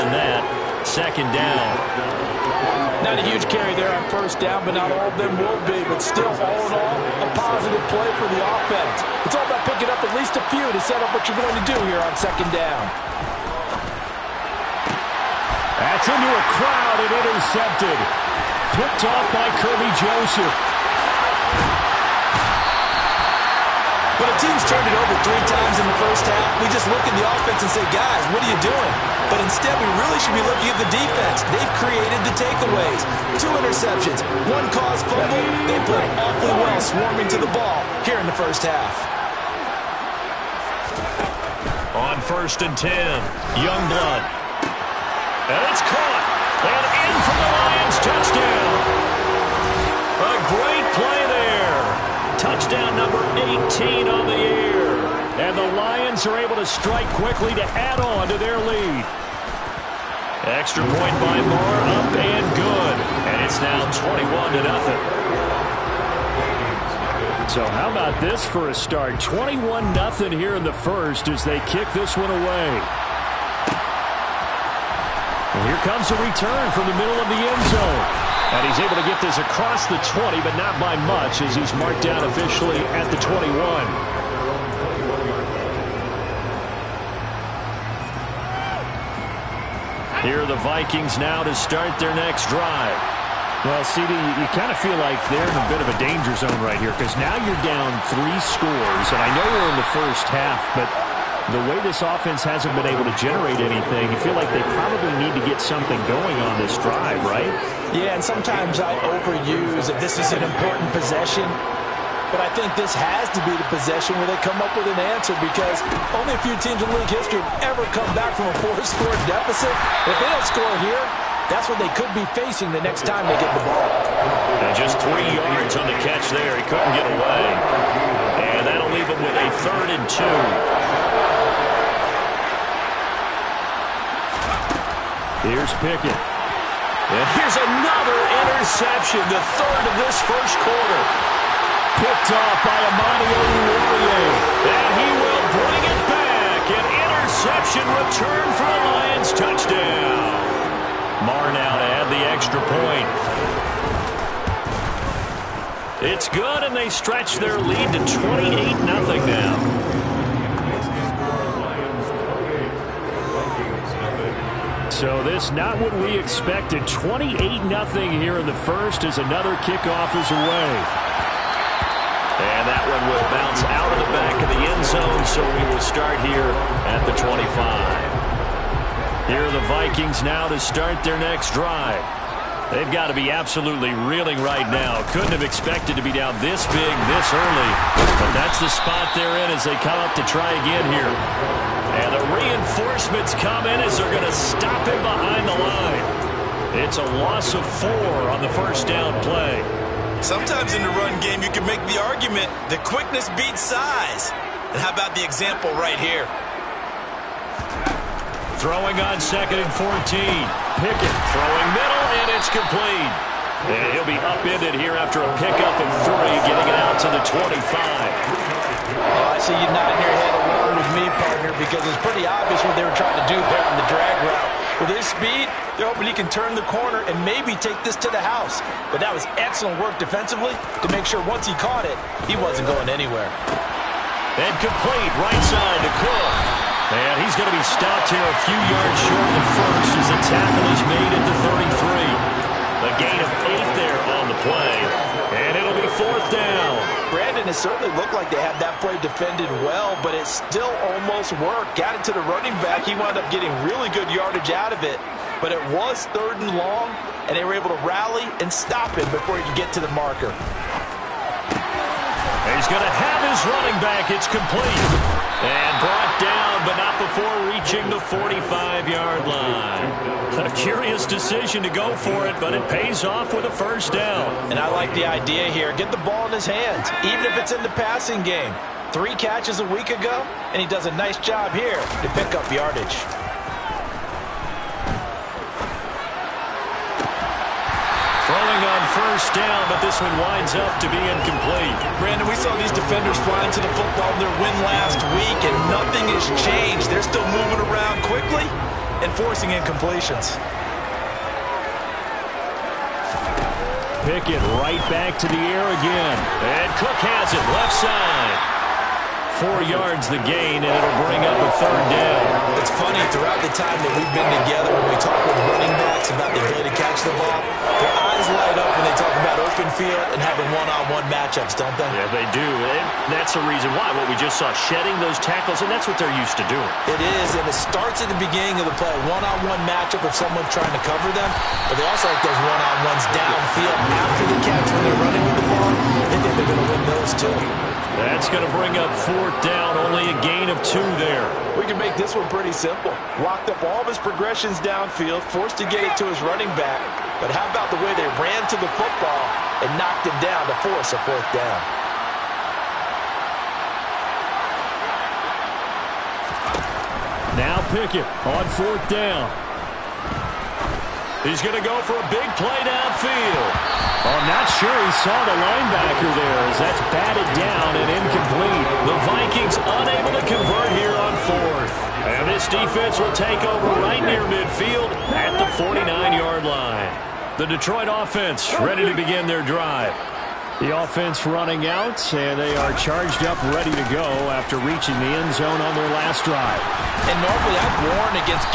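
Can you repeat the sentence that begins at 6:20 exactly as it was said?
The offense running out, and they are charged up, ready to go after reaching the end zone on their last drive.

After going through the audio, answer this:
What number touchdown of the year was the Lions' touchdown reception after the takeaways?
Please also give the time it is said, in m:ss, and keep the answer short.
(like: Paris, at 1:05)
18, at 0:53.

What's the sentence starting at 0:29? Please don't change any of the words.
But instead, we really should be looking at the defense.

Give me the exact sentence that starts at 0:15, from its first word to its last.
That's into a crowd and intercepted.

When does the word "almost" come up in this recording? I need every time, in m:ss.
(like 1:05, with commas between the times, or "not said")
4:10.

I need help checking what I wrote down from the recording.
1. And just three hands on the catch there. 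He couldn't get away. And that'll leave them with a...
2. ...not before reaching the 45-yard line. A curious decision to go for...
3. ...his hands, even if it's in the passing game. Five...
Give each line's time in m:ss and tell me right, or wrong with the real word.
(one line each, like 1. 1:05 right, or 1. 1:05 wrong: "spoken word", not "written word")
1. 2:04 wrong: "yards", not "hands"
2. 4:26 right
3. 4:36 wrong: "Three", not "Five".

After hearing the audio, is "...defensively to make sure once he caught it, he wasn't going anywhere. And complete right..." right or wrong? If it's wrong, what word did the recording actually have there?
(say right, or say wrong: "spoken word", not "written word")
right.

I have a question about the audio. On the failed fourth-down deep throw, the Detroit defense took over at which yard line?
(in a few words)
49.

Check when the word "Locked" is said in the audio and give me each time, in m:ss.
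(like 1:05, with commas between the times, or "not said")
5:43.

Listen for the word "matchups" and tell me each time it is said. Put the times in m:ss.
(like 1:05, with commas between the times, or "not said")
5:21, 5:29.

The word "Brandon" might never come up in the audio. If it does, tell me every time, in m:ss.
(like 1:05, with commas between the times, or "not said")
4:07, 4:52.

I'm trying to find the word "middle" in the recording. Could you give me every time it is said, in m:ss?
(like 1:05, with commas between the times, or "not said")
1:16, 3:31.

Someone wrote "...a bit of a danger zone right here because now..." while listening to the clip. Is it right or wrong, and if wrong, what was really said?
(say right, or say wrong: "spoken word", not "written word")
right.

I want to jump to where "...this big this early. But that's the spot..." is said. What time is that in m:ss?
3:06.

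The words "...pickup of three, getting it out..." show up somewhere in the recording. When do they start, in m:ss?
3:35.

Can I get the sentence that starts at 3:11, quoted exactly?
And the reinforcements come in as they're going to stop him behind the line.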